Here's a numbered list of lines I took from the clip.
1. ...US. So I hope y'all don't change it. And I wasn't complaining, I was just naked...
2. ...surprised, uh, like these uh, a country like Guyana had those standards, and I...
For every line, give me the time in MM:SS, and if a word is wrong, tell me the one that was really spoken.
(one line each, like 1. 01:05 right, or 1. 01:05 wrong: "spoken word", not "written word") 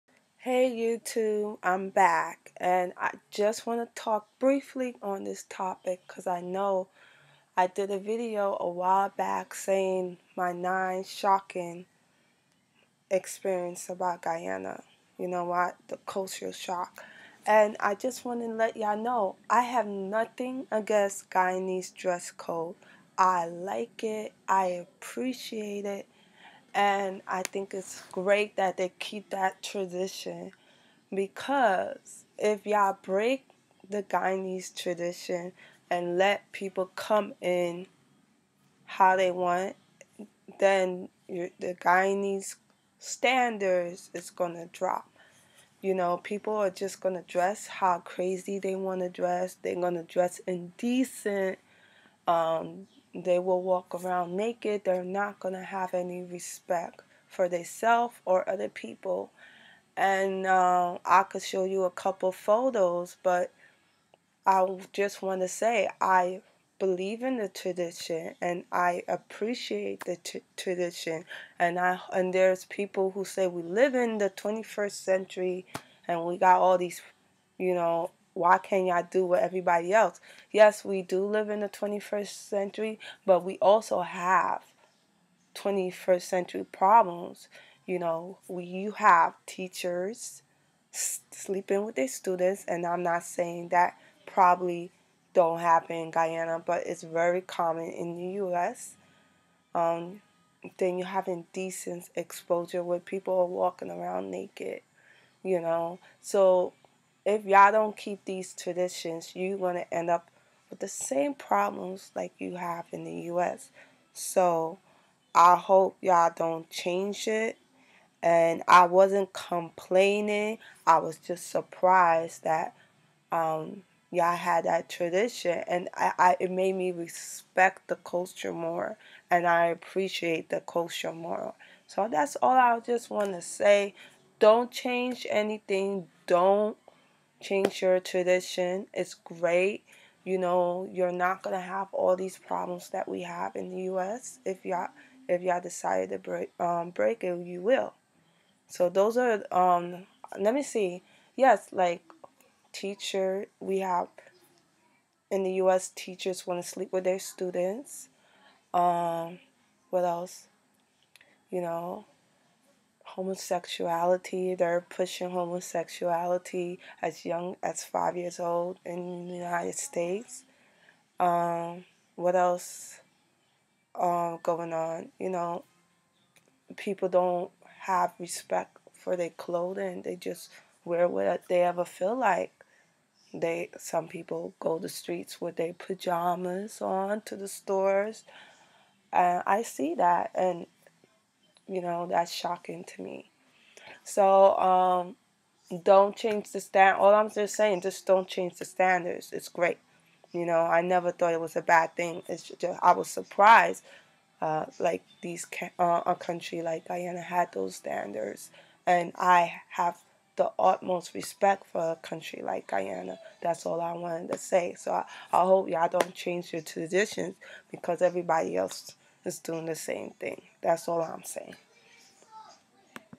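1. 01:53 wrong: "surprised", not "naked"
2. 03:23 right.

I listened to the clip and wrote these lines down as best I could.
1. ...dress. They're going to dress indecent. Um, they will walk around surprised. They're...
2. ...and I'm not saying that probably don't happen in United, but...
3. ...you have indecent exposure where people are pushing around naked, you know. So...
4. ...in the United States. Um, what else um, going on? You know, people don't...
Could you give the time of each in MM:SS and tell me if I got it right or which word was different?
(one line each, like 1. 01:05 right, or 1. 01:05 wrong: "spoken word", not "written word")
1. 00:49 wrong: "naked", not "surprised"
2. 01:32 wrong: "Guyana", not "United"
3. 01:40 wrong: "walking", not "pushing"
4. 02:48 right.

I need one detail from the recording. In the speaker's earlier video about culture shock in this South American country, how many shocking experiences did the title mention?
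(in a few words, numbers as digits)
9.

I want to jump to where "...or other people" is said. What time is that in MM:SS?
00:58.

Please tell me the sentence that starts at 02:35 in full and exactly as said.
Teachers want to sleep with their students.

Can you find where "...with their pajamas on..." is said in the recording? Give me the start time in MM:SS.
03:05.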